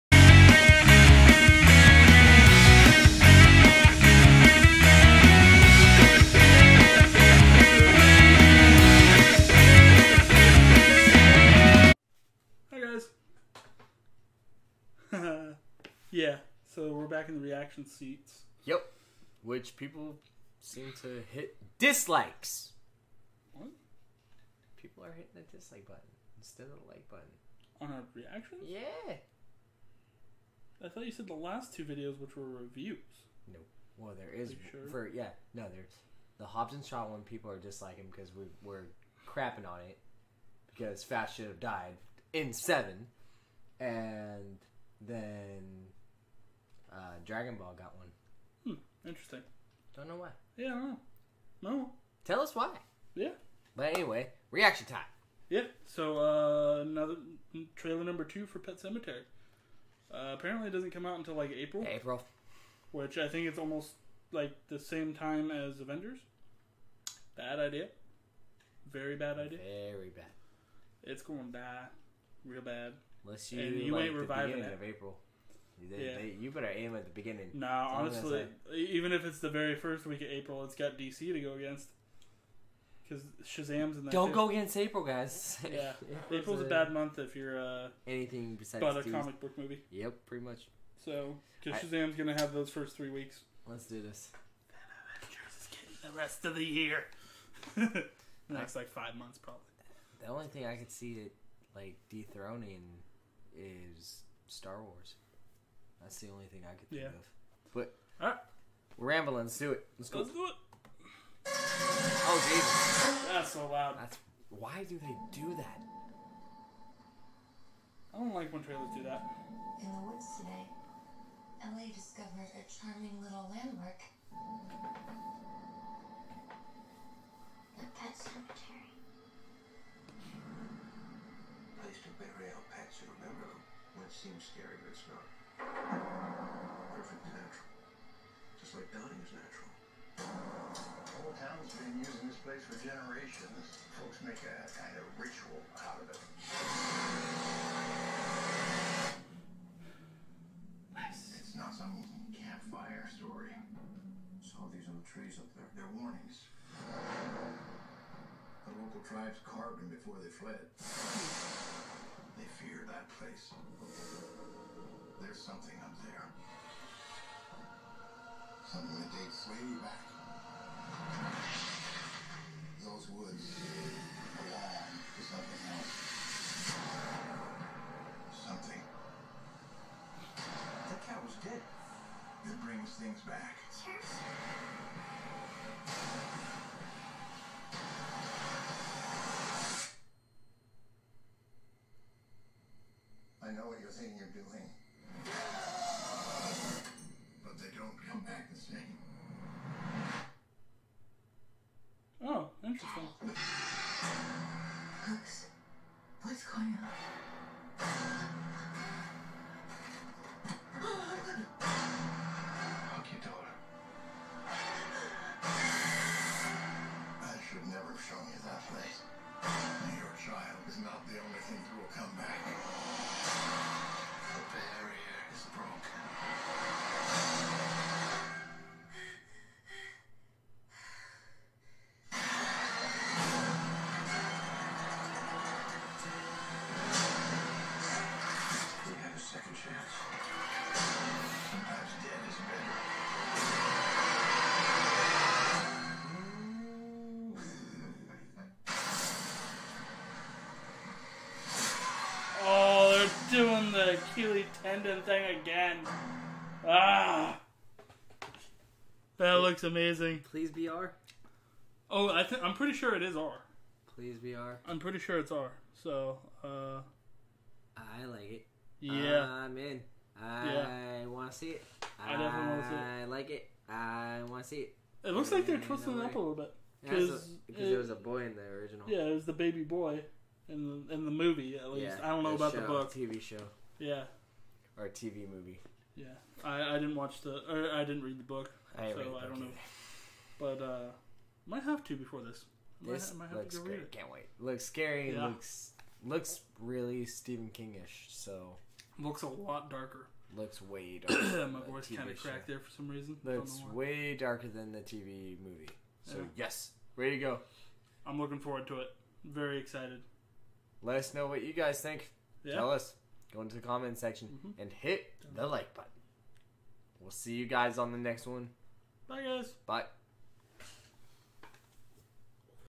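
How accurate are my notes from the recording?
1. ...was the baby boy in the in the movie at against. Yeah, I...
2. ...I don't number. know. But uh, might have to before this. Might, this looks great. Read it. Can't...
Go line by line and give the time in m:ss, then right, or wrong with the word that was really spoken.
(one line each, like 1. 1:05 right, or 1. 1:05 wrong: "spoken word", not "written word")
1. 4:39 wrong: "least", not "against"
2. 4:49 wrong: "either", not "number".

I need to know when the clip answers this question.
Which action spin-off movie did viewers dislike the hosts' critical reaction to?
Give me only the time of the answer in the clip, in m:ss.
0:36.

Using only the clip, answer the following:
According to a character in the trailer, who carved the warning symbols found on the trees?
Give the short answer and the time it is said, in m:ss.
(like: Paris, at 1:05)
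The local tribes, at 2:36.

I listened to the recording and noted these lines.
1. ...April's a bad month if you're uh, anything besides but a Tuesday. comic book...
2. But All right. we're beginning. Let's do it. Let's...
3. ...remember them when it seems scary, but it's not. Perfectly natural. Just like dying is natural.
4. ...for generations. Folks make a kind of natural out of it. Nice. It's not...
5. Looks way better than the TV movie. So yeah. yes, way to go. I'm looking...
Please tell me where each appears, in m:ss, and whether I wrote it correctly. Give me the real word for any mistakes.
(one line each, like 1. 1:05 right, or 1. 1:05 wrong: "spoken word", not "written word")
1. 1:26 right
2. 1:47 wrong: "rambling", not "beginning"
3. 2:13 right
4. 2:22 wrong: "ritual", not "natural"
5. 5:03 wrong: "darker", not "better".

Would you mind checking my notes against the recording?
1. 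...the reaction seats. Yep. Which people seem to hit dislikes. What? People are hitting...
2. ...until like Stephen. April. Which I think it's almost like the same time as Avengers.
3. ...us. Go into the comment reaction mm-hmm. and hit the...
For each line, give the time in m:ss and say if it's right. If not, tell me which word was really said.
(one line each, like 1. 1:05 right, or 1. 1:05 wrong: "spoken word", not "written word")
1. 0:17 right
2. 1:01 wrong: "April", not "Stephen"
3. 5:12 wrong: "section", not "reaction".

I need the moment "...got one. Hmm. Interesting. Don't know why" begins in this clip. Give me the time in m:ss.
0:47.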